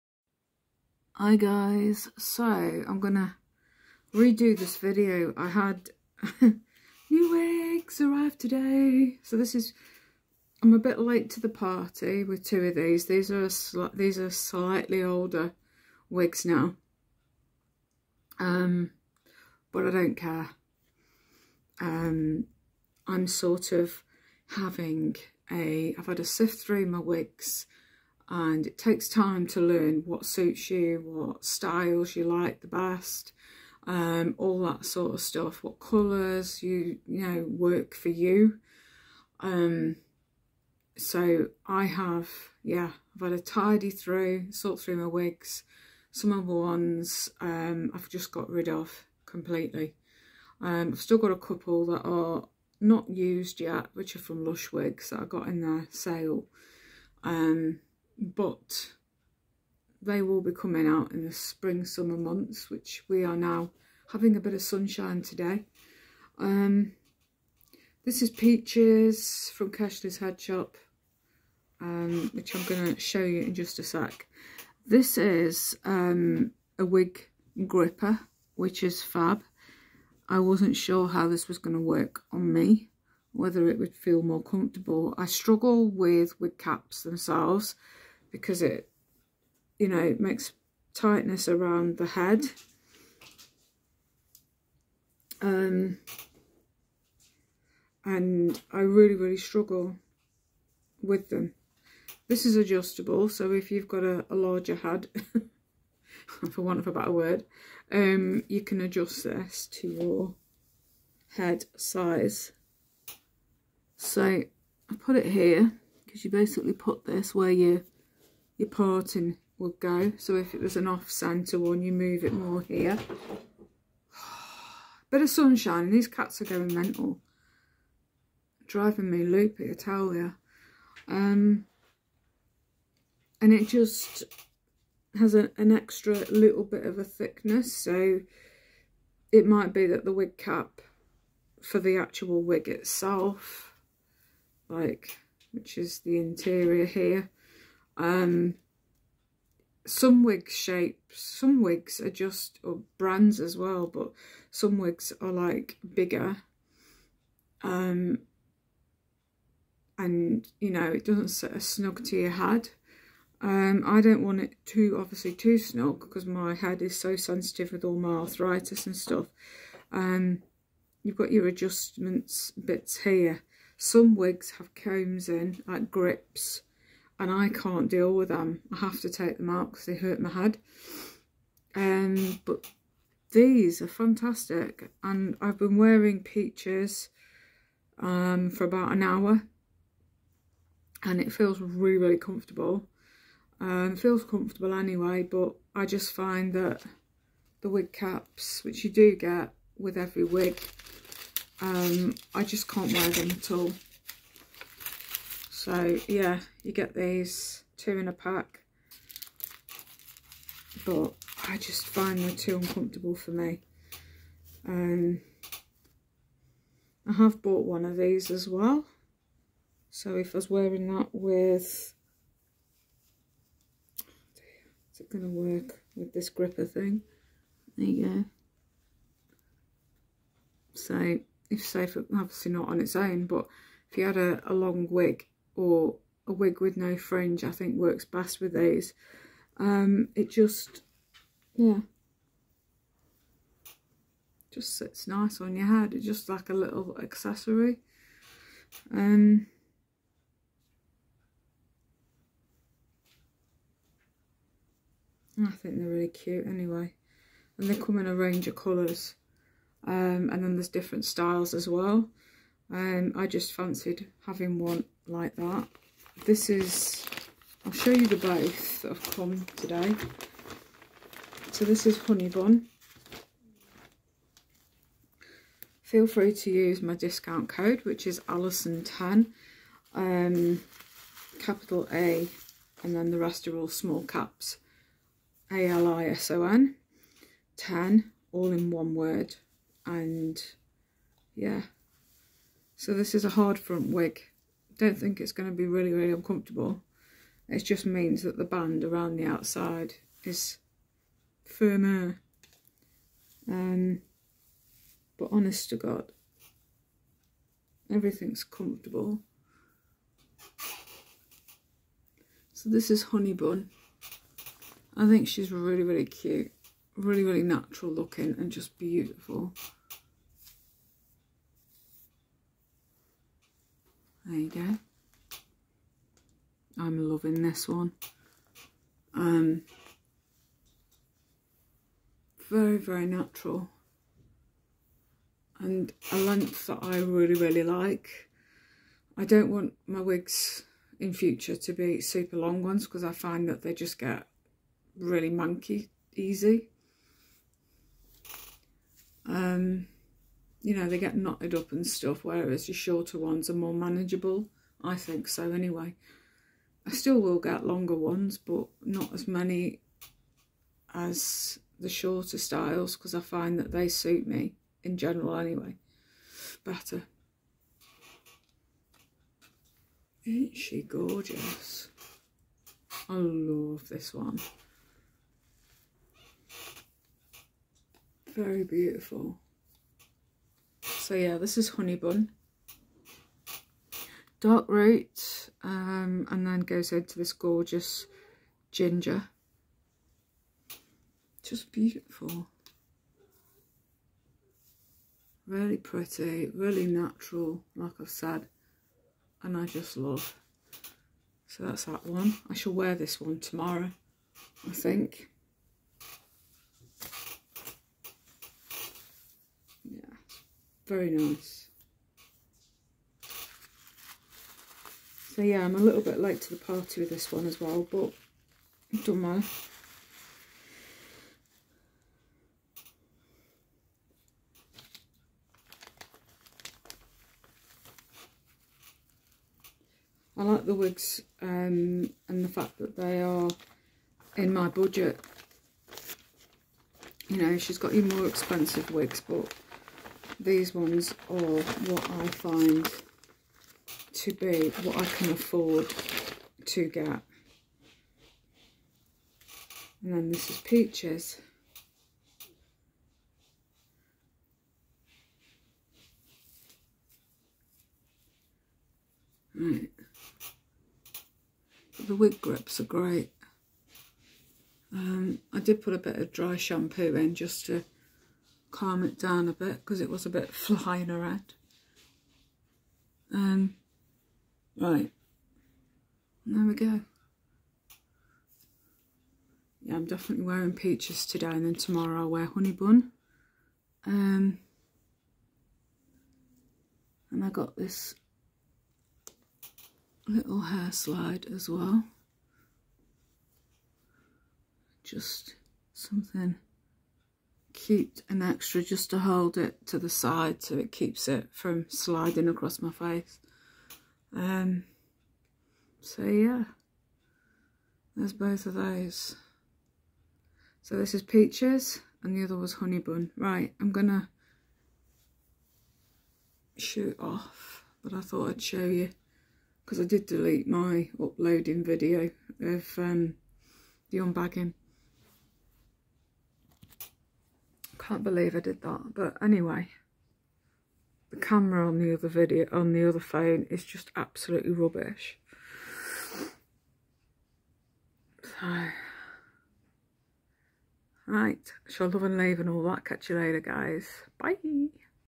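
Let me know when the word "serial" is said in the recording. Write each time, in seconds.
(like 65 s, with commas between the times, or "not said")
not said.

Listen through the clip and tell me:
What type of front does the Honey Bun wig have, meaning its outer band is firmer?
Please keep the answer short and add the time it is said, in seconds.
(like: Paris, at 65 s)
hard front, at 293 s.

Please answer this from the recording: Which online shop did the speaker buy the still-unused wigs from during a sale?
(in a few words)
Lush Wigs.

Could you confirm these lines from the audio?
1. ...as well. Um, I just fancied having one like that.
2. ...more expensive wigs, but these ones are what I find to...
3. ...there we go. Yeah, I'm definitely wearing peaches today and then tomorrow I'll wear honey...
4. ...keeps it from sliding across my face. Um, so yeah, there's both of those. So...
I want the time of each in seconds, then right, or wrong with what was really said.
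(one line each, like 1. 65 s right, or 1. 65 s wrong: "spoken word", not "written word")
1. 261 s right
2. 438 s right
3. 476 s right
4. 500 s right.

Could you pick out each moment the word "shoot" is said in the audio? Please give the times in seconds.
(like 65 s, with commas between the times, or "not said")
497 s, 516 s.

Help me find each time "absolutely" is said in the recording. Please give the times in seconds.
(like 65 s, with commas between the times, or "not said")
534 s.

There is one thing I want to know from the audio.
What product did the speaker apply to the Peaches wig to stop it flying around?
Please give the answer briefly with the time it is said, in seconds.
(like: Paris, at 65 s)
dry shampoo, at 466 s.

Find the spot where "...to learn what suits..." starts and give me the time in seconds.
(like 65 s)
29 s.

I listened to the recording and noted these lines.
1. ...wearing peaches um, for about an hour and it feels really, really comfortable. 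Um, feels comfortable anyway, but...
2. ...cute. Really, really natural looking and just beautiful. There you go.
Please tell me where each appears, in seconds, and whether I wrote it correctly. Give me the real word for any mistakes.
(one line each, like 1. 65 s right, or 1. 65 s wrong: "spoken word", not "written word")
1. 185 s right
2. 316 s right.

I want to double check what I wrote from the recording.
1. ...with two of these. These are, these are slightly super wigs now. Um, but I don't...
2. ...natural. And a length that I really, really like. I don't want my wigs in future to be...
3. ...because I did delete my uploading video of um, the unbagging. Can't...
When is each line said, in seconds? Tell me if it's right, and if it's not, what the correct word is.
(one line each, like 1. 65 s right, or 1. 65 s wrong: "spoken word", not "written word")
1. 12 s wrong: "older", not "super"
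2. 333 s right
3. 519 s right.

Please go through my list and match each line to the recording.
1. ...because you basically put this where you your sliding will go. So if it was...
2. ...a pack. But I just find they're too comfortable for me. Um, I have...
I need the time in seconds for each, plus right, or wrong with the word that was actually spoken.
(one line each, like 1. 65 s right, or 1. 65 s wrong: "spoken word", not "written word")
1. 116 s wrong: "parting", not "sliding"
2. 208 s wrong: "uncomfortable", not "comfortable".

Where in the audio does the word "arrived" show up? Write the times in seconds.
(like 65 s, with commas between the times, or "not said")
8 s.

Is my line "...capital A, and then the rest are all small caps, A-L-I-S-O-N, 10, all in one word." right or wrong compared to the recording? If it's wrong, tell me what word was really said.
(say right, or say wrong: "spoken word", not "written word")
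right.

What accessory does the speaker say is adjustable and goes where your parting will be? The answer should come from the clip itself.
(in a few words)
wig gripper.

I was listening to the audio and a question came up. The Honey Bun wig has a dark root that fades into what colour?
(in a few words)
ginger.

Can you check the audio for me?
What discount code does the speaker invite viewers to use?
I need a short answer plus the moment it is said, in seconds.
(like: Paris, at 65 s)
Alison10, at 278 s.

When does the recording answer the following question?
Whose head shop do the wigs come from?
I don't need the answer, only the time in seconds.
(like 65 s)
69 s.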